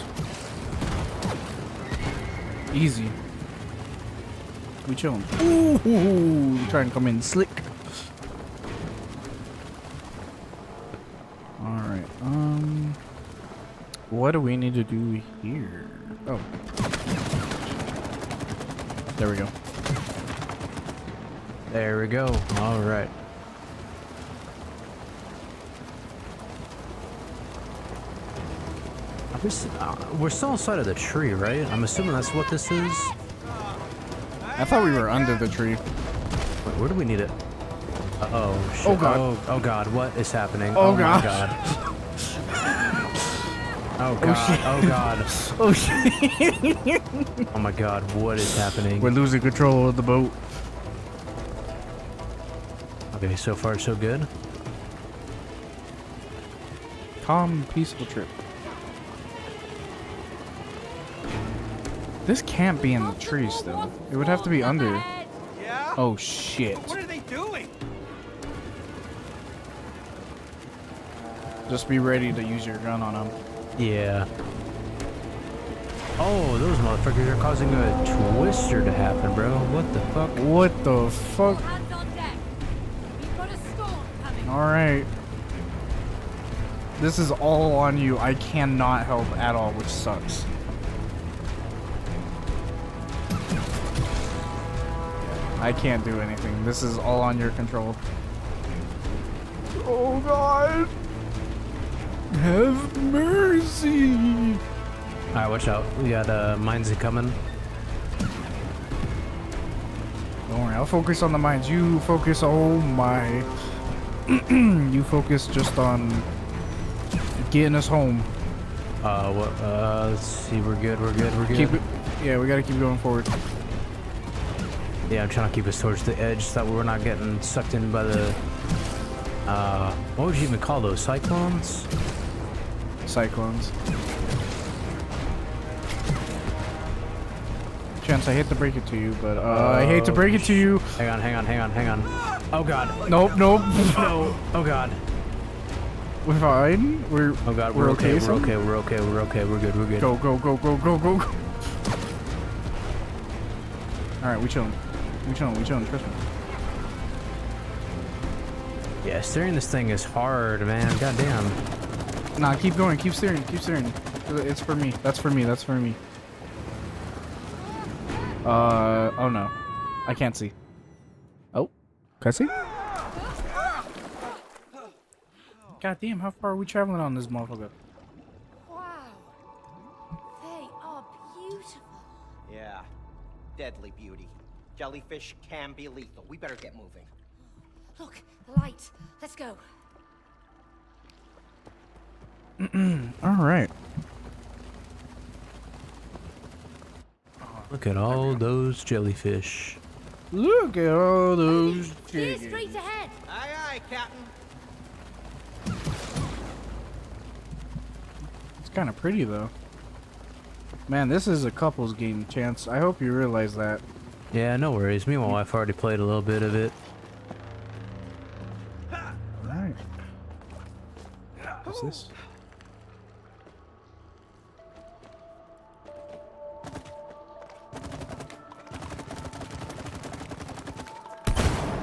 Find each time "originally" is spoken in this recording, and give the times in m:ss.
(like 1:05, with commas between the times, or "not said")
not said.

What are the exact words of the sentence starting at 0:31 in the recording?
I'm assuming that's what this is.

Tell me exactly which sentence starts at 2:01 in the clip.
Keep it, yeah, we gotta keep going forward.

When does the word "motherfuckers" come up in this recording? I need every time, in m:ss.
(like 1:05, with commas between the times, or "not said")
1:16, 2:57.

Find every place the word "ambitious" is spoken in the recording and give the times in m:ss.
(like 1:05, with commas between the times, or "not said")
not said.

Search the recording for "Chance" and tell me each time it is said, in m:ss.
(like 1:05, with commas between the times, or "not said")
2:18, 3:32.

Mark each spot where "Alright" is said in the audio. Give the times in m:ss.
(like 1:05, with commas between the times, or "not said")
0:11, 0:22, 1:24, 1:45, 3:39.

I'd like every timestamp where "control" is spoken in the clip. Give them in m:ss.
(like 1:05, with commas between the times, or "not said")
0:49, 1:37.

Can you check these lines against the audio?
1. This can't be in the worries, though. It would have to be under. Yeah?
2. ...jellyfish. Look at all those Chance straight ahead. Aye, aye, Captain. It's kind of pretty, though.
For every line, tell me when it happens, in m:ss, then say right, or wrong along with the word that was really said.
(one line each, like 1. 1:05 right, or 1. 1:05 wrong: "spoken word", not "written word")
1. 1:02 wrong: "trees", not "worries"
2. 3:18 wrong: "Clear", not "Chance".